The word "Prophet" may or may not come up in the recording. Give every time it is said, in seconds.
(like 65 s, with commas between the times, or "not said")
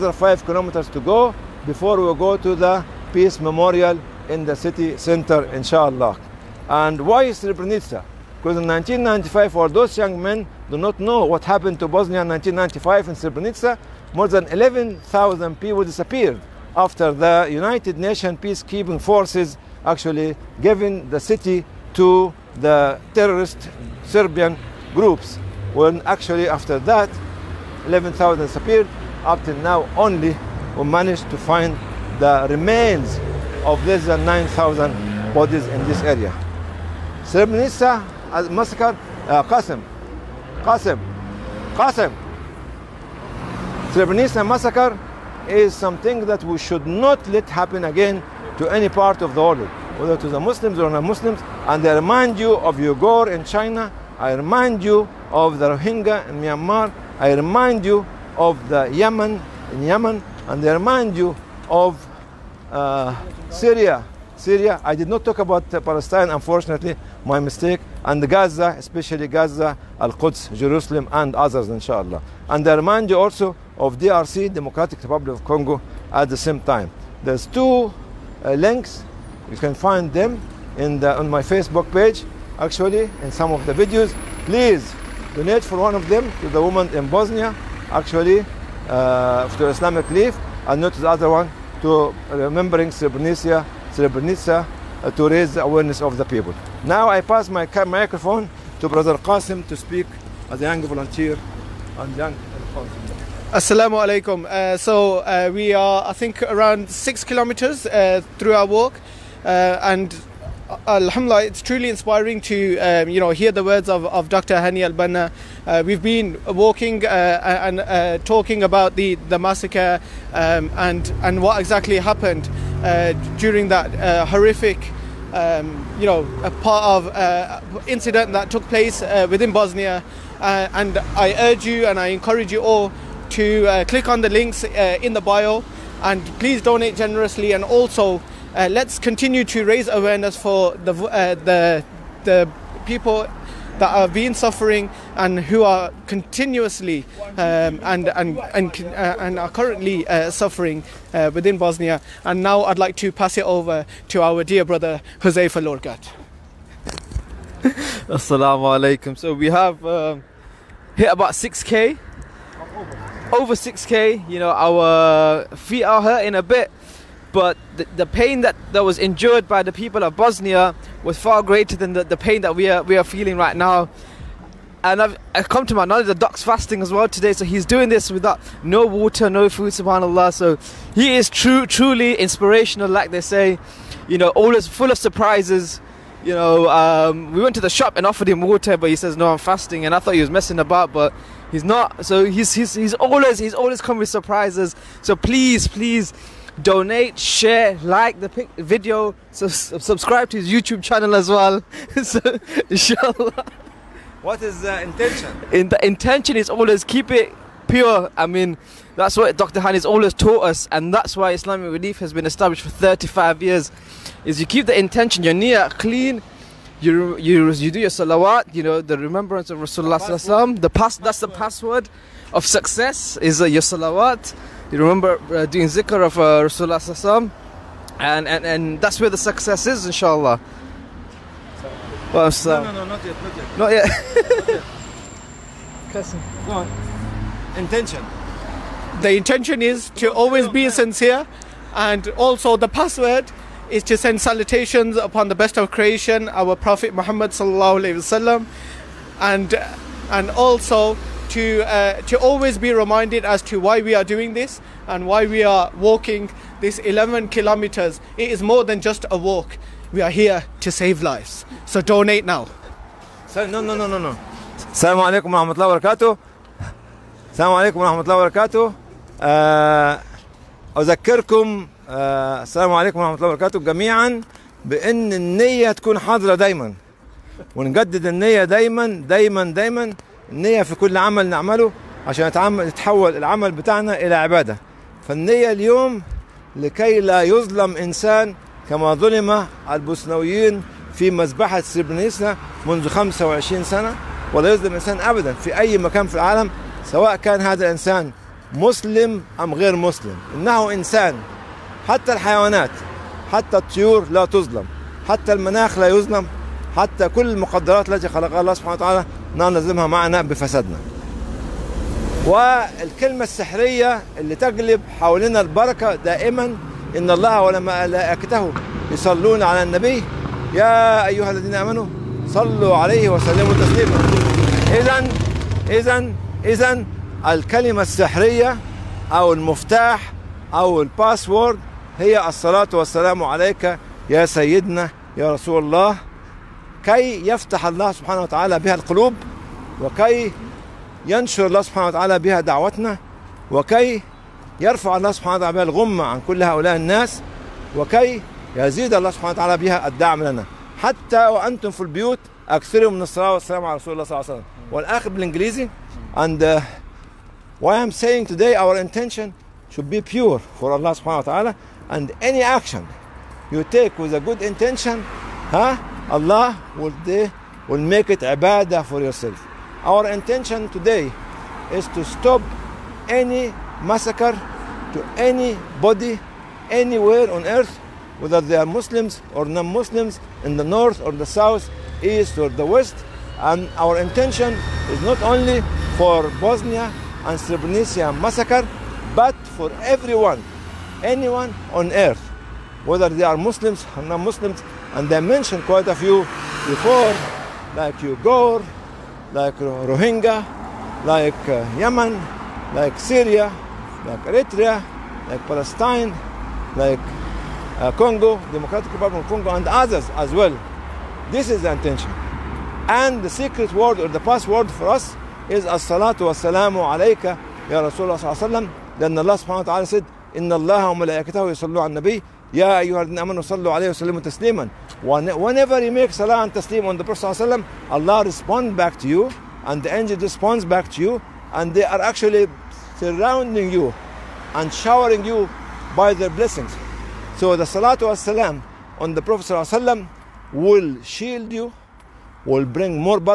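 246 s, 427 s, 439 s.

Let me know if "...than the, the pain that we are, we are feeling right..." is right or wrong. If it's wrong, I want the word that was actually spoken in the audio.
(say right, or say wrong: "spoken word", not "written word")
right.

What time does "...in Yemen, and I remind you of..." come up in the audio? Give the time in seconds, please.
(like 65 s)
59 s.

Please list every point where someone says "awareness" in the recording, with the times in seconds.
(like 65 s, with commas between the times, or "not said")
95 s, 139 s.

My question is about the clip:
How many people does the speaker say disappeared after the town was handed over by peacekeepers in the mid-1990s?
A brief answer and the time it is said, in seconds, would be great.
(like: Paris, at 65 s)
11,000, at 14 s.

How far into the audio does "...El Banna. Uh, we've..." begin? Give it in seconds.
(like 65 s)
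114 s.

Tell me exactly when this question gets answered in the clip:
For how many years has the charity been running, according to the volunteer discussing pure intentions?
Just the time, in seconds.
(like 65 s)
212 s.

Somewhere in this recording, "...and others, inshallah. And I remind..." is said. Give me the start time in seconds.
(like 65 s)
71 s.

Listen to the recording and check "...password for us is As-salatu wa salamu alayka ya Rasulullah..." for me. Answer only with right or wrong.
right.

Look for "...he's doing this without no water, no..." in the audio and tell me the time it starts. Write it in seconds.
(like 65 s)
177 s.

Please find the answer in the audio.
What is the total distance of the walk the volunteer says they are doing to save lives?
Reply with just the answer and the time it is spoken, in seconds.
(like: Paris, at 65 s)
11 kilometers, at 256 s.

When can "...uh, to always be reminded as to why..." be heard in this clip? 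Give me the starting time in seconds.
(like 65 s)
251 s.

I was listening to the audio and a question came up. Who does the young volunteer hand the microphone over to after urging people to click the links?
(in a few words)
Huzaifa Lorgat.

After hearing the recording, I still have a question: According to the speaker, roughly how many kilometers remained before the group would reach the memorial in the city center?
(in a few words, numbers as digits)
5.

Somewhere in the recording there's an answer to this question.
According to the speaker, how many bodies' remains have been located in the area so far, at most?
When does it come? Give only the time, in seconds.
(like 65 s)
33 s.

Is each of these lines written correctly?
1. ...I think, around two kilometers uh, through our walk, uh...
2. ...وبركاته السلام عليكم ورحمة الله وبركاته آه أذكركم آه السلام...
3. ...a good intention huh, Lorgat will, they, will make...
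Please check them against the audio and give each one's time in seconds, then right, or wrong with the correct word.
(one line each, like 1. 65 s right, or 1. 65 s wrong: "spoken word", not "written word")
1. 106 s wrong: "six", not "two"
2. 265 s right
3. 364 s wrong: "Allah", not "Lorgat".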